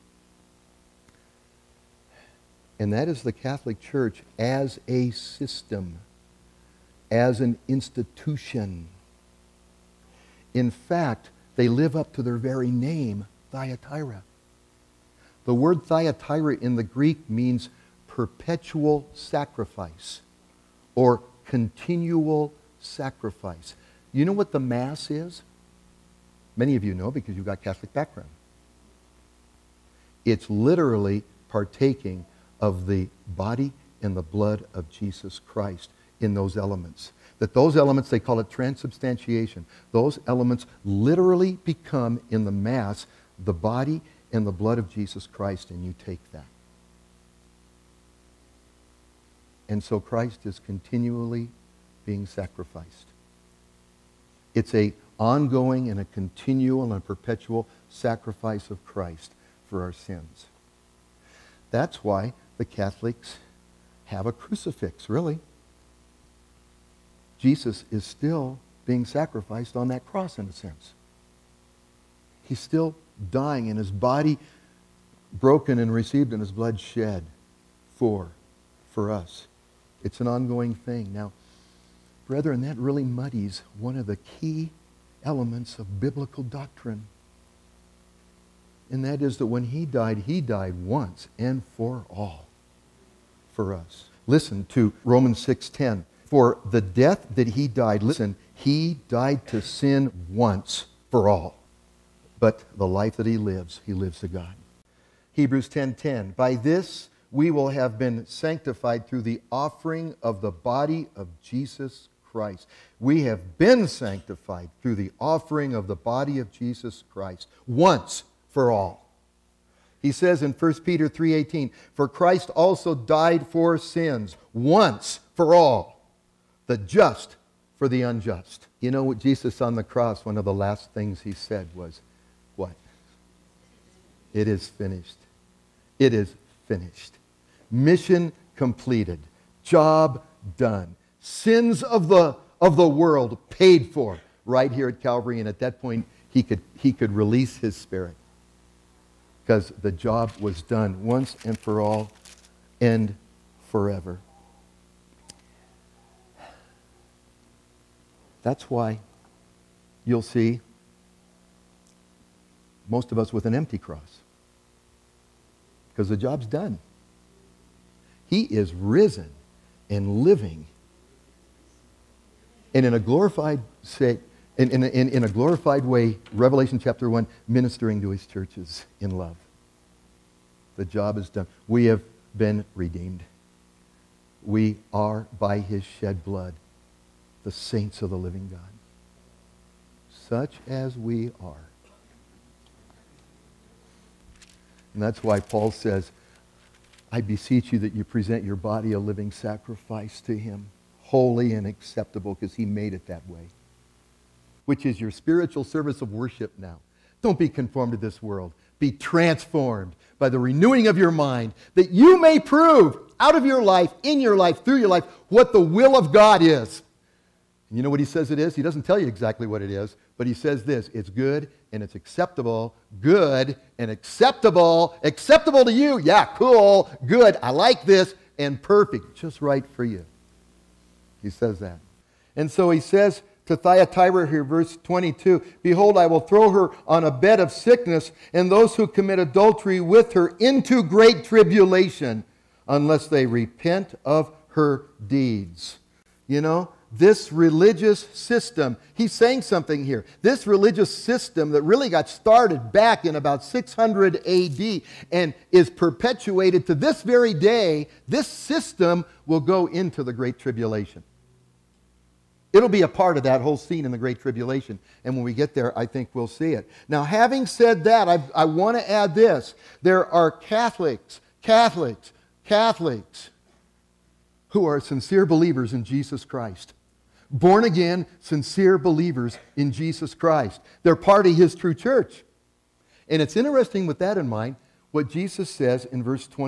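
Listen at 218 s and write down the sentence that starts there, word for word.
He doesn't tell you exactly what it is, but he says this it's good and it's acceptable.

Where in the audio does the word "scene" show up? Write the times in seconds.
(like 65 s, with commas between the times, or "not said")
263 s.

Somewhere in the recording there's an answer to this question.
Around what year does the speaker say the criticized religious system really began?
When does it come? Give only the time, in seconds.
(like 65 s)
253 s.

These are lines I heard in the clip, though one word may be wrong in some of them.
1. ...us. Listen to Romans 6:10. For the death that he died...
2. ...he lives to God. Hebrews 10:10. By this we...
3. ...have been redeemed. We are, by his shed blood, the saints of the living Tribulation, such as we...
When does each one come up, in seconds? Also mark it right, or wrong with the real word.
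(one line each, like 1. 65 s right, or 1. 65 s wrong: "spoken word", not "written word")
1. 93 s right
2. 103 s right
3. 181 s wrong: "God", not "Tribulation".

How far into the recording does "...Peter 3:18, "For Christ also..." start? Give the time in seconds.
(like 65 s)
120 s.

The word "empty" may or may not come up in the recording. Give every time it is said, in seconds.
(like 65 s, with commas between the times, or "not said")
163 s.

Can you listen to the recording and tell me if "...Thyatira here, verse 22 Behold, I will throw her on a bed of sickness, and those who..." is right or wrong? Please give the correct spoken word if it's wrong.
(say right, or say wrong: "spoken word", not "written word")
right.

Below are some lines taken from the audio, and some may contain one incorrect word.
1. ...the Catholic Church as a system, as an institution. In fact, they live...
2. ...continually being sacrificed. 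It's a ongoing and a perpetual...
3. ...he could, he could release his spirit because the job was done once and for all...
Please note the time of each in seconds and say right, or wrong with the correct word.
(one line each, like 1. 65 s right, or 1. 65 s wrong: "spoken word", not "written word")
1. 3 s right
2. 50 s wrong: "continual", not "perpetual"
3. 146 s right.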